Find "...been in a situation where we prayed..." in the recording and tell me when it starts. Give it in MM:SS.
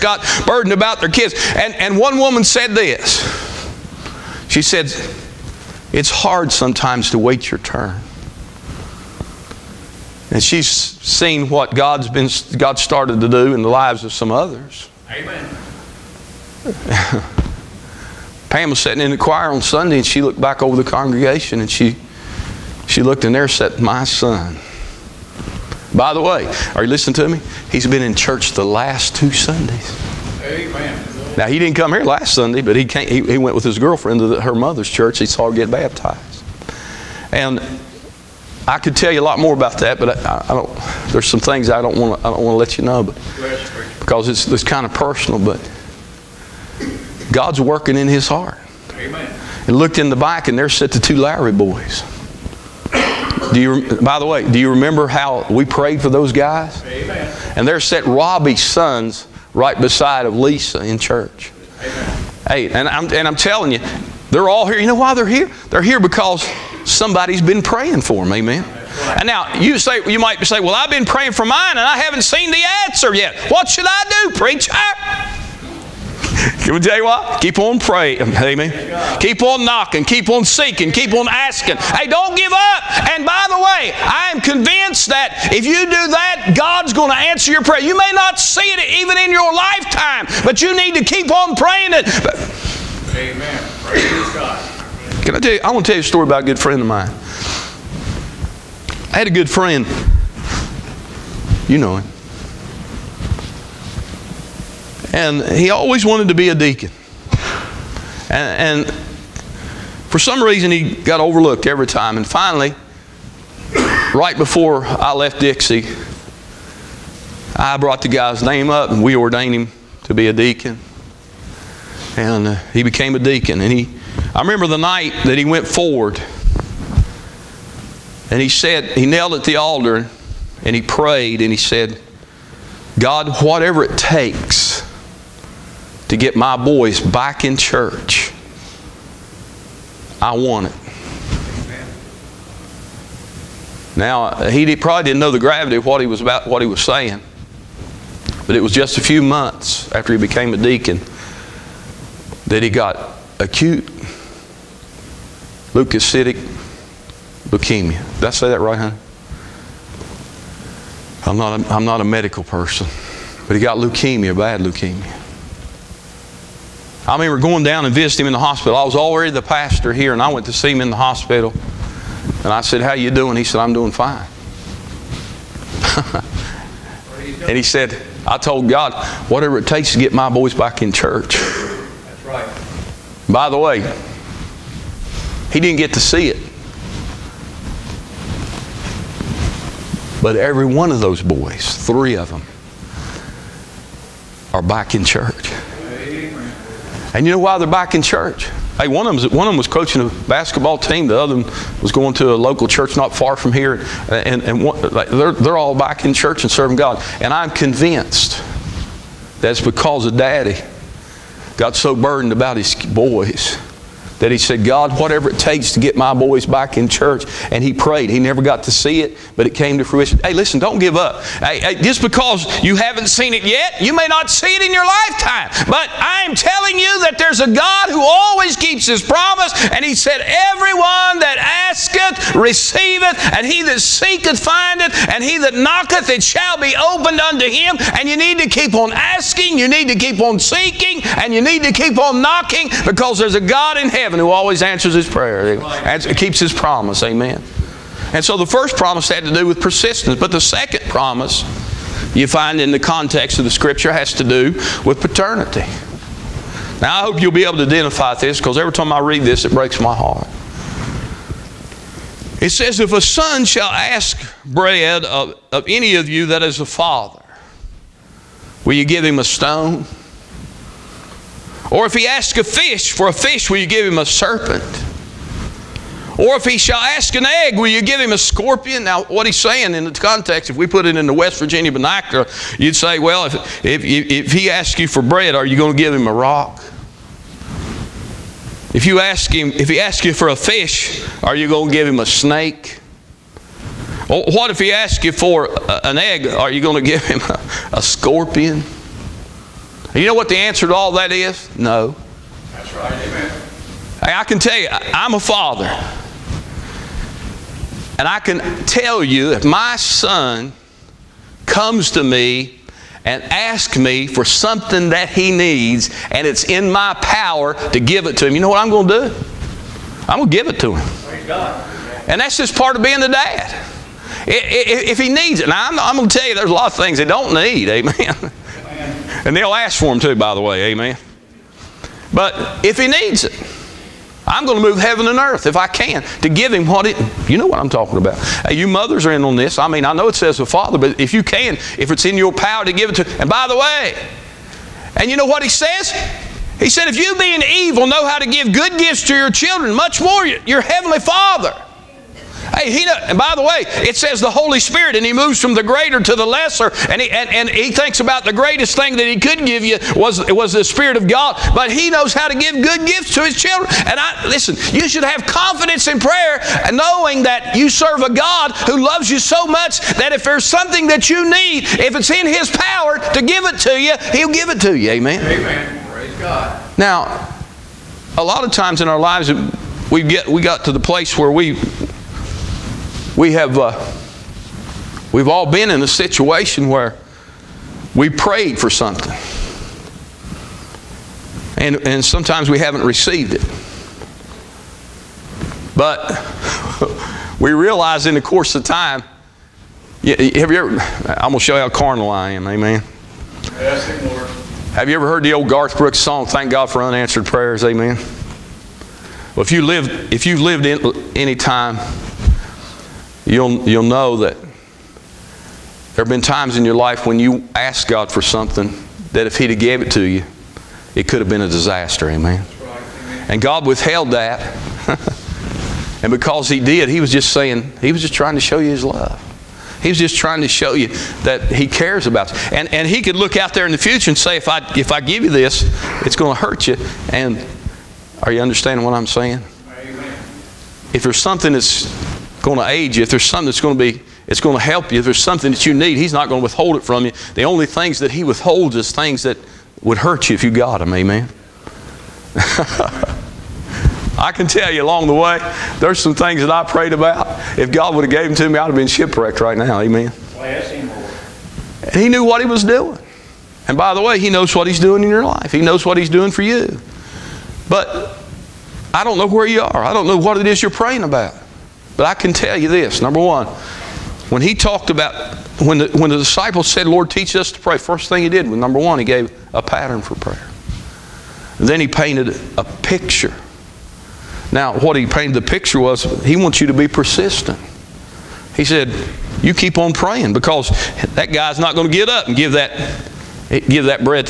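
06:25.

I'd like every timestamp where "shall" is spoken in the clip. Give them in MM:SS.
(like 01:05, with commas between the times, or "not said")
03:56, 04:23, 04:36.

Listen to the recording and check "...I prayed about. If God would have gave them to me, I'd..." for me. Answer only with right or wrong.
right.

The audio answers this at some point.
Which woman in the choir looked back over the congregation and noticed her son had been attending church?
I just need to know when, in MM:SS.
00:18.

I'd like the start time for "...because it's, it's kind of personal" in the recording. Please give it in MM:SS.
00:43.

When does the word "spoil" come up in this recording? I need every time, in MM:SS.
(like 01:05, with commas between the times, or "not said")
not said.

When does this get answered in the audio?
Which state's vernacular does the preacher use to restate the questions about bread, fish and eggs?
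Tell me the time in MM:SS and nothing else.
04:41.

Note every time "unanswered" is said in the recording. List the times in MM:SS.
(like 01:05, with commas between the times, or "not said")
06:46.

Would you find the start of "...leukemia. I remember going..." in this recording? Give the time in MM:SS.
02:44.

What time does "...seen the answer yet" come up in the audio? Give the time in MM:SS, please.
01:12.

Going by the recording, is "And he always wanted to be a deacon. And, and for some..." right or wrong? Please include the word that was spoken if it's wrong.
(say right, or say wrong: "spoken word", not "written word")
right.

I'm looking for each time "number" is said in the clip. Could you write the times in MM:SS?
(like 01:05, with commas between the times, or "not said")
07:52, 07:58.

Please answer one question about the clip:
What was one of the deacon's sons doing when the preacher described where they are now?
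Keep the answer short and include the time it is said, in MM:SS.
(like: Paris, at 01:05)
coaching a basketball team, at 03:19.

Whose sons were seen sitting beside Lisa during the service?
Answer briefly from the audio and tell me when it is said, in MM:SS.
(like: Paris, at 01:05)
Robbie's sons, at 00:58.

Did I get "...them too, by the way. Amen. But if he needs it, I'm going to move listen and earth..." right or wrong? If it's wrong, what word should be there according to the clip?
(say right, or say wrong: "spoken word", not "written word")
wrong: "heaven", not "listen".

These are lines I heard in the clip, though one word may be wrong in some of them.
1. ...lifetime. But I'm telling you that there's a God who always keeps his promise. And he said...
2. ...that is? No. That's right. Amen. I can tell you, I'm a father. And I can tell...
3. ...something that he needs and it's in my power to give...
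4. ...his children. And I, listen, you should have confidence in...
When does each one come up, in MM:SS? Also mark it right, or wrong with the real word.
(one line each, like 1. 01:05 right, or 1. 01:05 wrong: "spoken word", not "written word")
1. 03:44 right
2. 05:00 right
3. 05:14 right
4. 06:03 right.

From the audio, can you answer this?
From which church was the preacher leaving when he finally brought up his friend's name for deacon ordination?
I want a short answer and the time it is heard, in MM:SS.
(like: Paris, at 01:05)
Dixie, at 01:55.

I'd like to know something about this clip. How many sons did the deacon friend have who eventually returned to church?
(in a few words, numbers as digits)
3.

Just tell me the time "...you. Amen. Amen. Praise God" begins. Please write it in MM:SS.
06:14.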